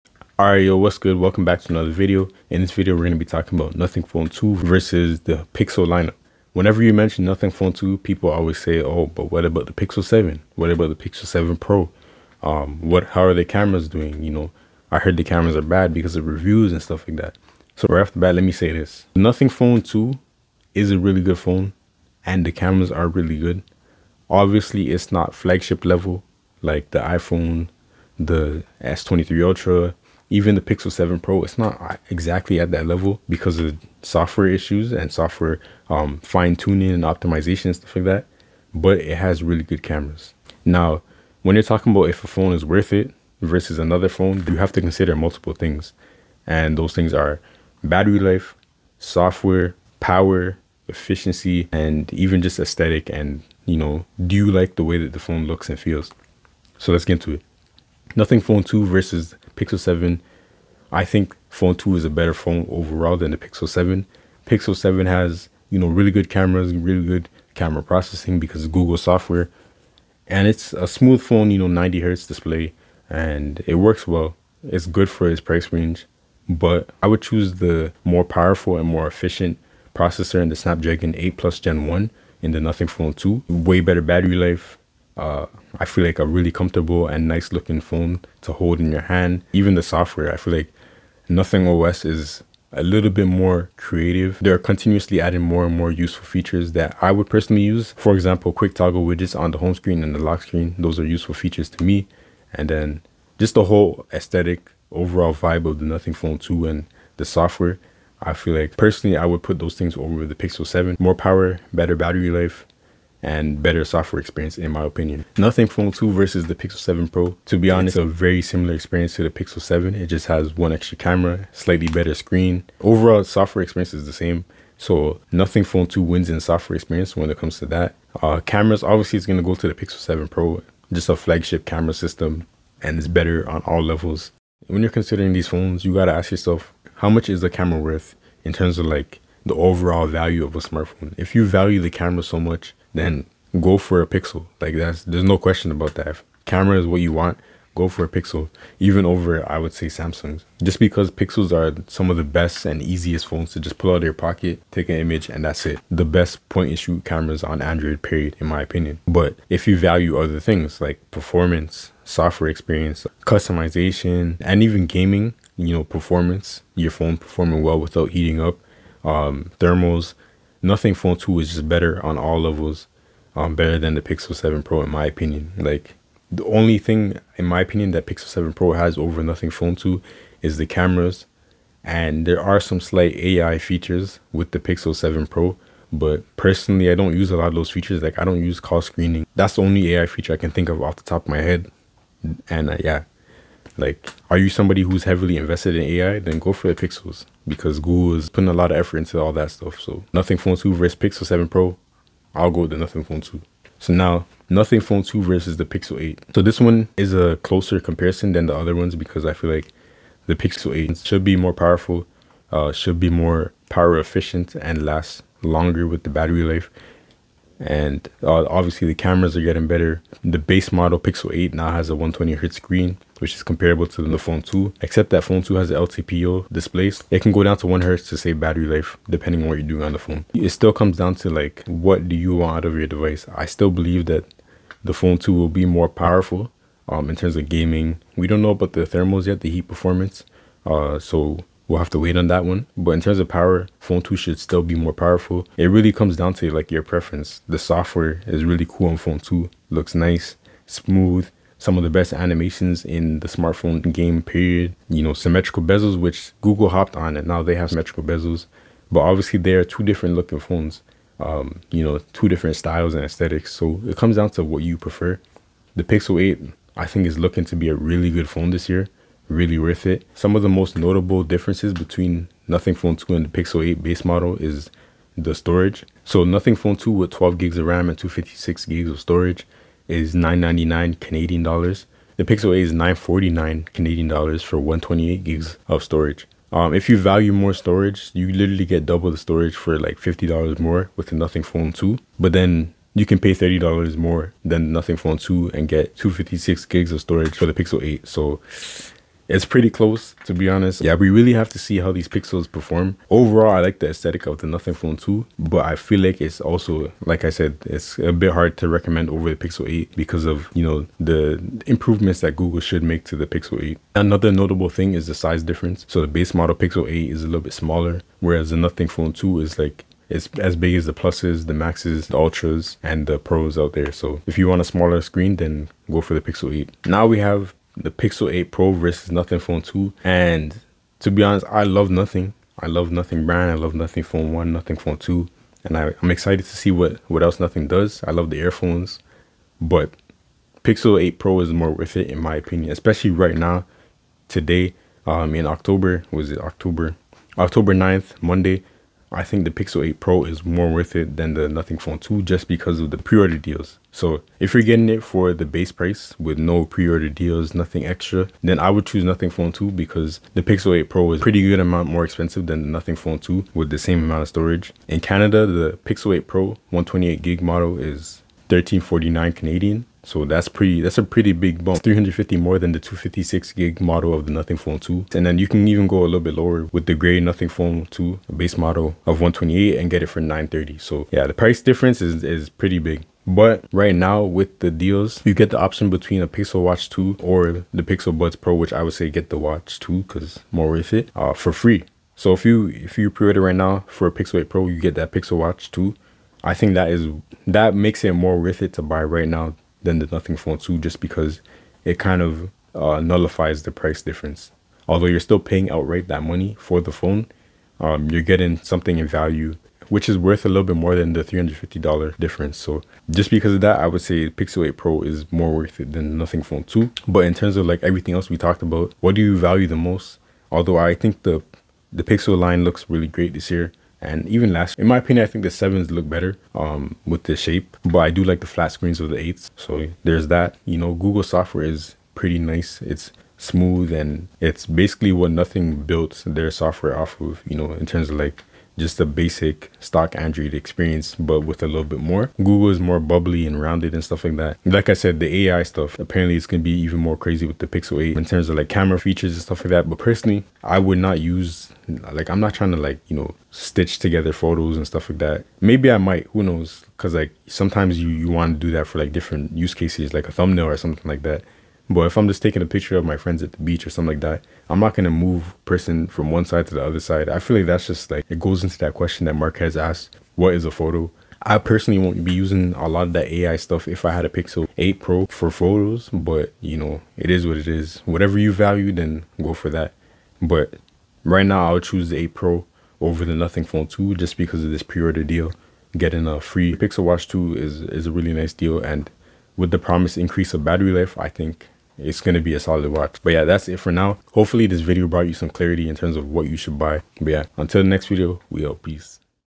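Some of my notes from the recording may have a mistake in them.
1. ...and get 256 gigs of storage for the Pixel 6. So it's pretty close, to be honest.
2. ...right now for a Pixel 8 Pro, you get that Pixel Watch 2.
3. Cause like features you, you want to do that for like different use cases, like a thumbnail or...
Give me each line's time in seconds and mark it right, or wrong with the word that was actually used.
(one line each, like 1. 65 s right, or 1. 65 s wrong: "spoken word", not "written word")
1. 295 s wrong: "8", not "6"
2. 393 s right
3. 456 s wrong: "sometimes", not "features".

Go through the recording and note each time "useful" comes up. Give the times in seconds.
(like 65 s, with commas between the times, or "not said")
95 s, 101 s.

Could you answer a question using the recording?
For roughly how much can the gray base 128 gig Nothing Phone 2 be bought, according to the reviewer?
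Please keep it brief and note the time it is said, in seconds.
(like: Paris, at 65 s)
930, at 380 s.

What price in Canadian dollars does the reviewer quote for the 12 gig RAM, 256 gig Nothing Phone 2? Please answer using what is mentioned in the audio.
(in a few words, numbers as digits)
999.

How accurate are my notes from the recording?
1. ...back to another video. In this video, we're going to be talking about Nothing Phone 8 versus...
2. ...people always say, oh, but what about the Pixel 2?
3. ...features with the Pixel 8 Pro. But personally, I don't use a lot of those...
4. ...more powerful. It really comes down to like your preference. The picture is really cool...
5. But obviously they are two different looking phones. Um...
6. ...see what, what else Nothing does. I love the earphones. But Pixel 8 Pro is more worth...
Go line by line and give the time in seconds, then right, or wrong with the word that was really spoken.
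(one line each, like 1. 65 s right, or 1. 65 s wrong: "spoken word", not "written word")
1. 1 s wrong: "2", not "8"
2. 7 s wrong: "7", not "2"
3. 183 s wrong: "7", not "8"
4. 244 s wrong: "software", not "picture"
5. 258 s right
6. 336 s right.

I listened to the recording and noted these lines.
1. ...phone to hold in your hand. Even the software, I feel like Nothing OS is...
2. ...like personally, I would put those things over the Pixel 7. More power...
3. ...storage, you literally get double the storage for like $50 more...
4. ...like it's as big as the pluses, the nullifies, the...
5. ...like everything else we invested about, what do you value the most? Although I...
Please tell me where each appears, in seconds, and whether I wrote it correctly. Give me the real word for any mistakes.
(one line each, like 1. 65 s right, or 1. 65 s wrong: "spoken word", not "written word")
1. 87 s right
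2. 108 s right
3. 287 s right
4. 319 s wrong: "maxes", not "nullifies"
5. 417 s wrong: "talked", not "invested".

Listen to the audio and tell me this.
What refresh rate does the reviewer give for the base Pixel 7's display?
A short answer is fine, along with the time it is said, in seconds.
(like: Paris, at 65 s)
90 hertz, at 71 s.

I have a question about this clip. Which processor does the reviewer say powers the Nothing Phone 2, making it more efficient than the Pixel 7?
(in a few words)
Snapdragon 8 Plus Gen 1.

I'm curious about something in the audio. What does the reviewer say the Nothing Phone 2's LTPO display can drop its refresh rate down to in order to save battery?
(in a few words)
1 hertz.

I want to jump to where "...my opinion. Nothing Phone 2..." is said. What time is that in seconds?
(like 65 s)
114 s.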